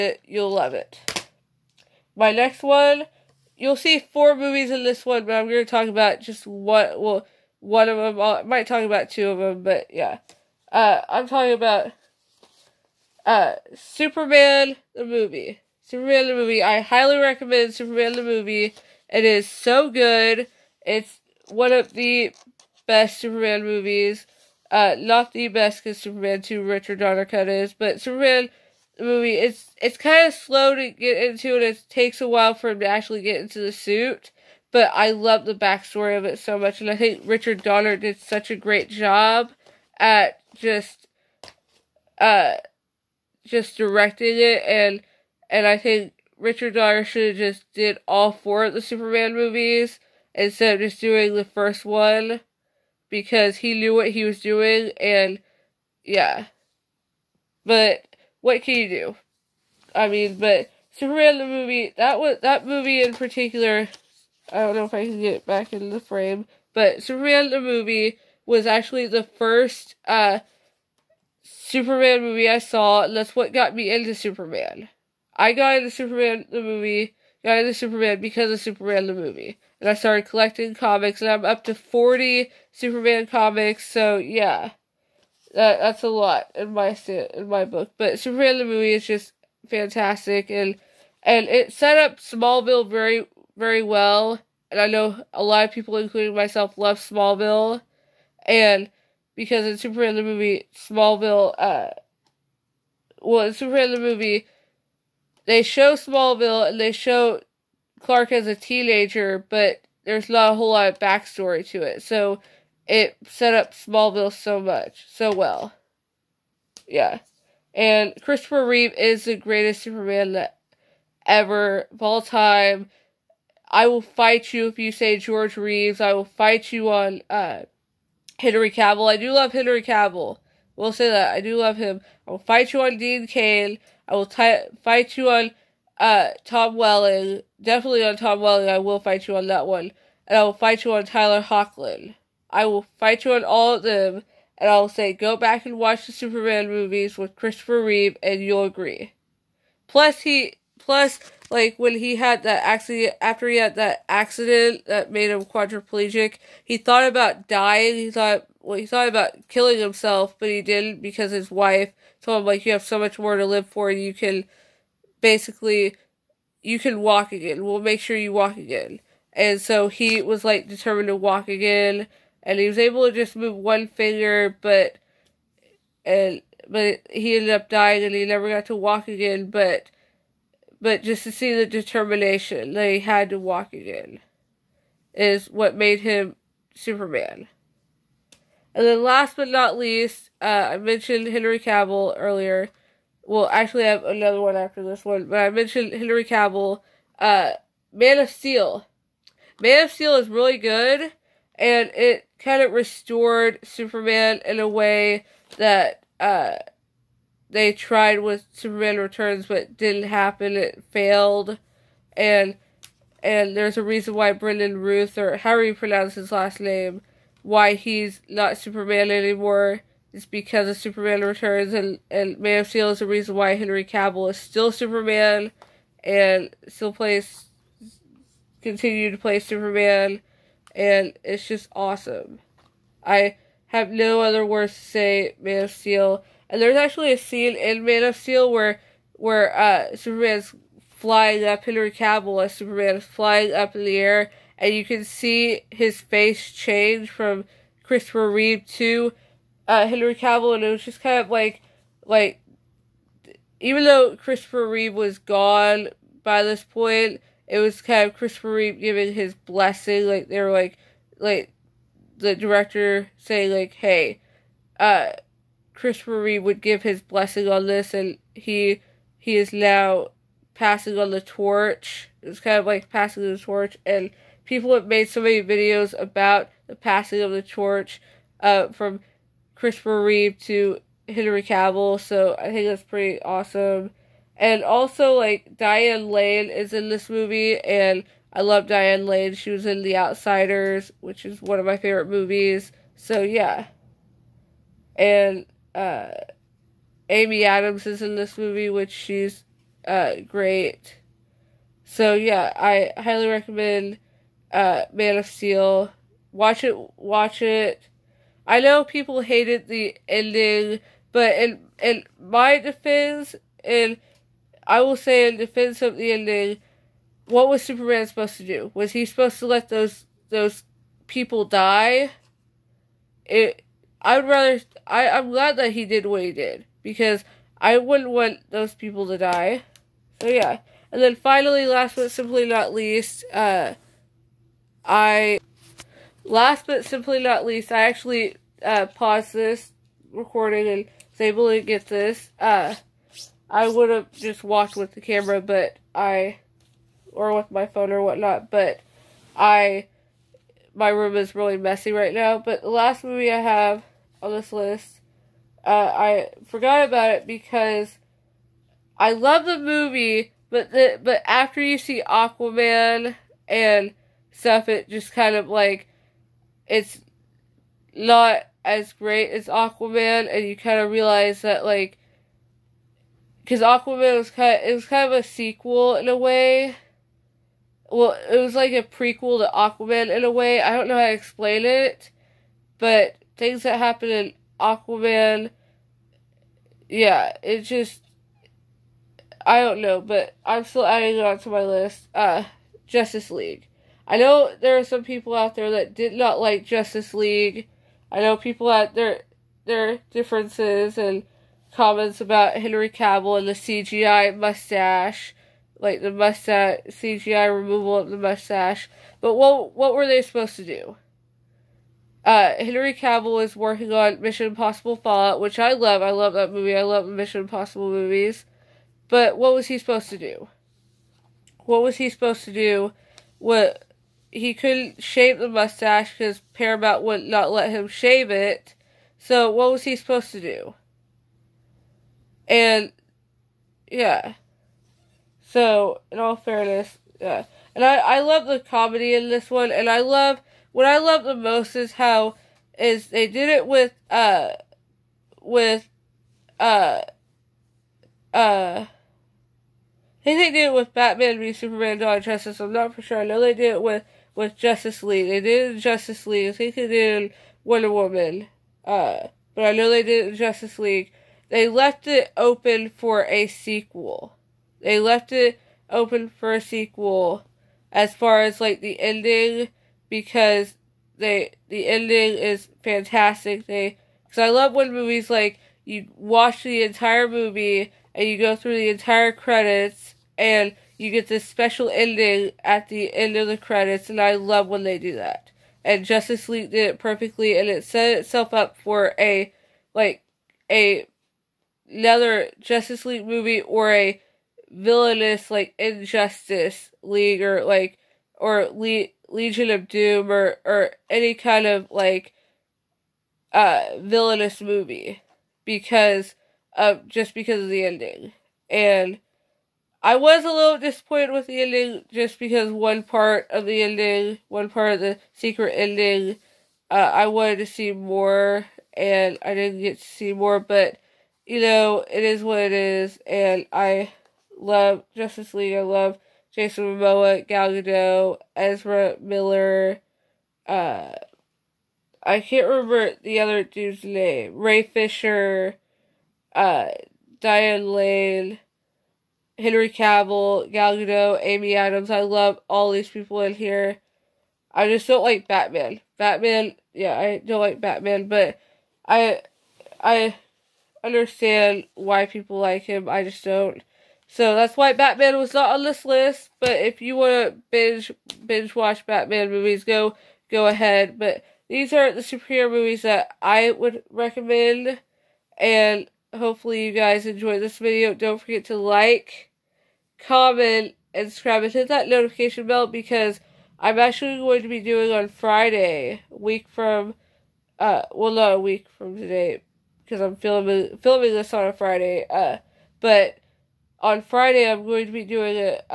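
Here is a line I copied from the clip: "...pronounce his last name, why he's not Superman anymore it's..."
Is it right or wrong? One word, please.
right.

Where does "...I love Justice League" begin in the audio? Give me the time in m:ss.
8:43.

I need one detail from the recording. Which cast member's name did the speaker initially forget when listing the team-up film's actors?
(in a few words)
Ray Fisher.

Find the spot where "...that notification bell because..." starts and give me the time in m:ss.
9:31.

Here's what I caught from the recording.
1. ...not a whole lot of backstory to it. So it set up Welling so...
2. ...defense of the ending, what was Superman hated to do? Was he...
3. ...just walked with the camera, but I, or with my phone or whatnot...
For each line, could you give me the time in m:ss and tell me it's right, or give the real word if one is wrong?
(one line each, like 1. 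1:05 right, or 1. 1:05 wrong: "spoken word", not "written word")
1. 1:50 wrong: "Smallville", not "Welling"
2. 5:15 wrong: "supposed", not "hated"
3. 5:44 right.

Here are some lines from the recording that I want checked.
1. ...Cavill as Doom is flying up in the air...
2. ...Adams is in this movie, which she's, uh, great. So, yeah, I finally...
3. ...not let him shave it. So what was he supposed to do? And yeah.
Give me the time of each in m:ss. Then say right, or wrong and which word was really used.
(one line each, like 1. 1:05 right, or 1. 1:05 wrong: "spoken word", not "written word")
1. 4:01 wrong: "Superman", not "Doom"
2. 4:57 wrong: "highly", not "finally"
3. 7:07 right.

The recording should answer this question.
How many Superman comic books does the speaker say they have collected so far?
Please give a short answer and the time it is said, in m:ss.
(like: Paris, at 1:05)
40, at 1:21.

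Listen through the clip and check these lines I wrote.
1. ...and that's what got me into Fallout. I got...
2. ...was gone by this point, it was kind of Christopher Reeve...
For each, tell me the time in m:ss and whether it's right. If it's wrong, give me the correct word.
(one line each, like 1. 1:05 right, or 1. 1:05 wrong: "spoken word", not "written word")
1. 1:13 wrong: "Superman", not "Fallout"
2. 4:14 right.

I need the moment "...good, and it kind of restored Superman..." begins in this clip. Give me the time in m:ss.
3:20.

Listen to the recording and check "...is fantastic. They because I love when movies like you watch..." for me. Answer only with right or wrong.
right.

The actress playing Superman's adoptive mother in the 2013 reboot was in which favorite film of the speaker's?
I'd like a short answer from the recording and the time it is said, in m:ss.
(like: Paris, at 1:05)
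The Outsiders, at 4:49.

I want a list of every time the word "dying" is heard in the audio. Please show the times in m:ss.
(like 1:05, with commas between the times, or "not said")
2:37, 2:57.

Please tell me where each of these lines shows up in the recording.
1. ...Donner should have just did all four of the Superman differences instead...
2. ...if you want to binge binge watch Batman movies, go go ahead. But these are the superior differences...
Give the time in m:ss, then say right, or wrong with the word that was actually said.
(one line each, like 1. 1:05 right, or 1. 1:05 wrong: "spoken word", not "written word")
1. 0:46 wrong: "movies", not "differences"
2. 9:16 wrong: "movies", not "differences".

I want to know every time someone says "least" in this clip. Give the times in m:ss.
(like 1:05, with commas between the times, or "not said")
3:09, 5:32, 5:37.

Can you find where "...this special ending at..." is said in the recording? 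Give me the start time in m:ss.
8:01.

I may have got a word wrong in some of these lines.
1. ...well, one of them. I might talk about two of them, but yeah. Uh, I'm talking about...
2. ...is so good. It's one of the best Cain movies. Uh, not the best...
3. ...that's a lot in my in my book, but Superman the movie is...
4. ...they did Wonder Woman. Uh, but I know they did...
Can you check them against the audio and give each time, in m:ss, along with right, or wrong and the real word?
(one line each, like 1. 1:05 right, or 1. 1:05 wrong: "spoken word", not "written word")
1. 0:07 right
2. 0:19 wrong: "Superman", not "Cain"
3. 1:25 right
4. 7:36 right.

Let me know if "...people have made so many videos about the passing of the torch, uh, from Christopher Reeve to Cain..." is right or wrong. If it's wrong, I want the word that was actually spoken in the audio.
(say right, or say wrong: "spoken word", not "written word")
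wrong: "Henry", not "Cain".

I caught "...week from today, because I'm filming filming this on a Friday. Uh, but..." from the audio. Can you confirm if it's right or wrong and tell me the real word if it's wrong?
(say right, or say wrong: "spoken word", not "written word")
right.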